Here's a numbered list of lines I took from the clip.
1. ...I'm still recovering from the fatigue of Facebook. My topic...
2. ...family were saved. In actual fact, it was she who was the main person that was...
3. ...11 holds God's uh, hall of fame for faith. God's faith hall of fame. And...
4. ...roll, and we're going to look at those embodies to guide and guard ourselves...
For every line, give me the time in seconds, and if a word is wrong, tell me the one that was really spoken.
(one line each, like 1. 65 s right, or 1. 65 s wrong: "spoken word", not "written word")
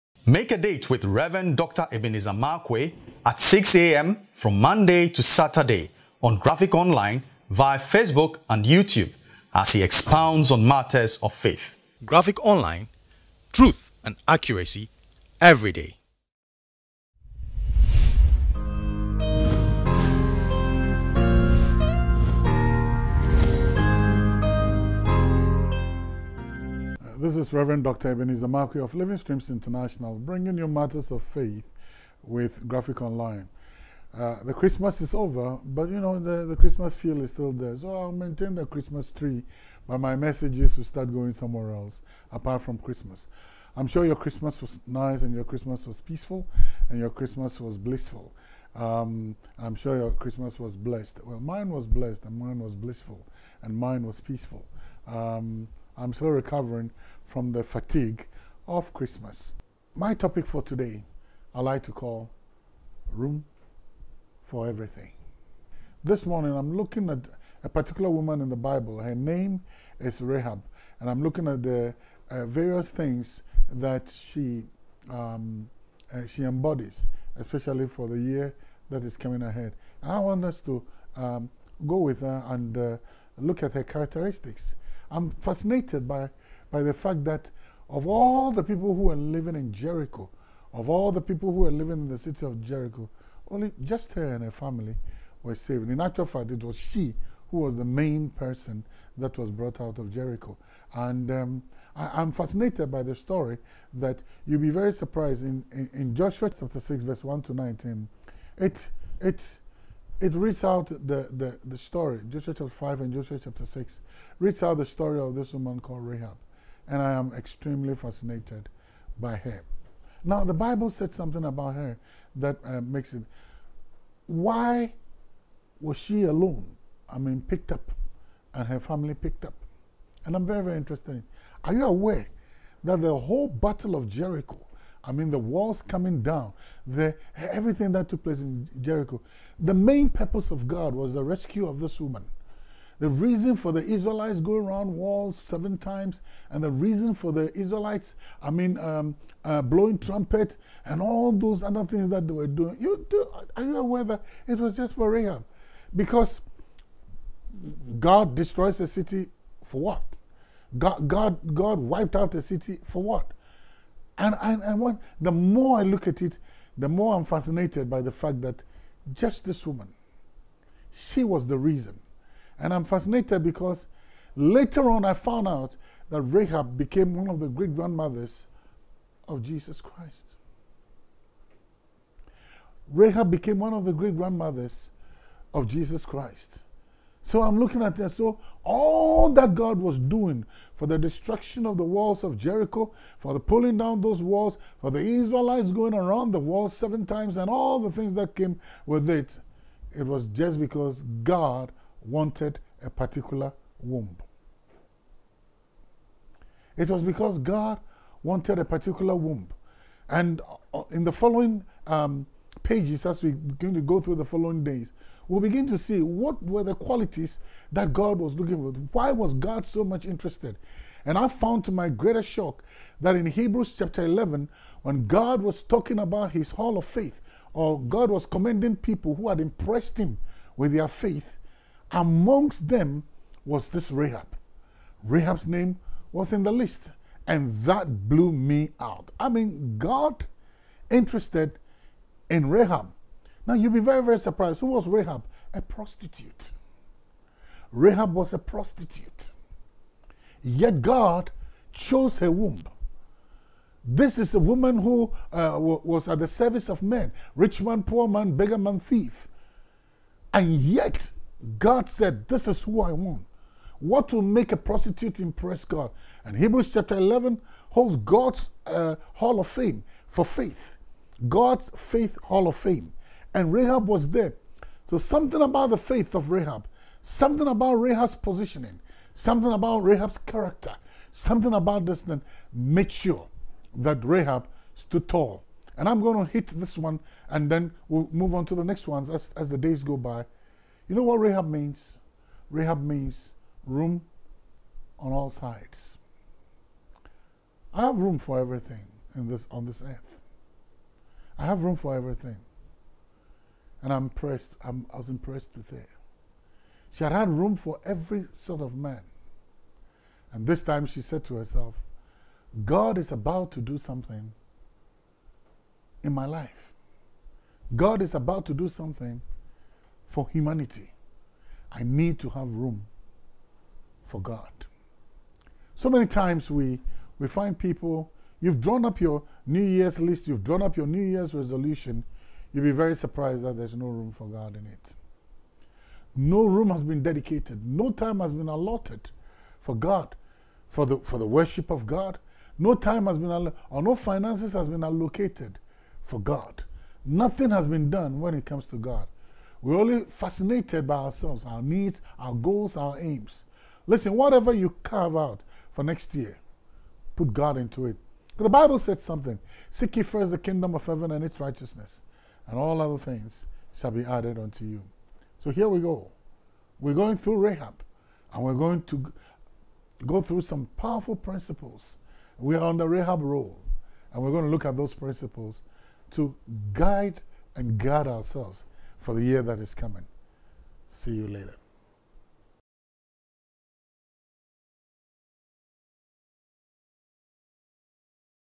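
1. 55 s wrong: "Christmas", not "Facebook"
2. 94 s right
3. 266 s right
4. 373 s wrong: "principles", not "embodies".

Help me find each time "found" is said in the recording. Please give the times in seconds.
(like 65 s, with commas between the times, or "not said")
175 s, 221 s.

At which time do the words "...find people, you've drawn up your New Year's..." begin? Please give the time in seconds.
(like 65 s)
327 s.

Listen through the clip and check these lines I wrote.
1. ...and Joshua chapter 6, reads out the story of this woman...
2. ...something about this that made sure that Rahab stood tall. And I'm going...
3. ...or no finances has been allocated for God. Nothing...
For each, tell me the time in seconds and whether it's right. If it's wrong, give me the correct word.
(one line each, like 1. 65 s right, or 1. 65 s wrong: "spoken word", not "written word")
1. 113 s right
2. 281 s right
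3. 343 s right.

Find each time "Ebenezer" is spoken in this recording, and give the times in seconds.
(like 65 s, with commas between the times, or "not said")
1 s, 28 s.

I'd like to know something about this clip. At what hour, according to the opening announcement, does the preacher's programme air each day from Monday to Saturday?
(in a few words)
6 a.m.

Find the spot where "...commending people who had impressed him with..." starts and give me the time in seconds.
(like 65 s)
228 s.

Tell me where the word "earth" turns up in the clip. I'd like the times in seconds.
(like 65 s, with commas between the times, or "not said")
299 s.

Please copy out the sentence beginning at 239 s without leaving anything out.
I mean, God interested in Rahab now you'll be very, very surprised.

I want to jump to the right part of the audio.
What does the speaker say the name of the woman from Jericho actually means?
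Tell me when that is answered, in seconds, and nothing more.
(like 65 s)
293 s.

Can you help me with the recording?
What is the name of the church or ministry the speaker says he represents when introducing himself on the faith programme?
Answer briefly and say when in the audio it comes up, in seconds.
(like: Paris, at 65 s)
Living Streams International, at 28 s.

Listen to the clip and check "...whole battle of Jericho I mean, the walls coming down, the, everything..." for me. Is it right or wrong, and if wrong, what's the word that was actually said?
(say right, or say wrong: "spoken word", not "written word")
right.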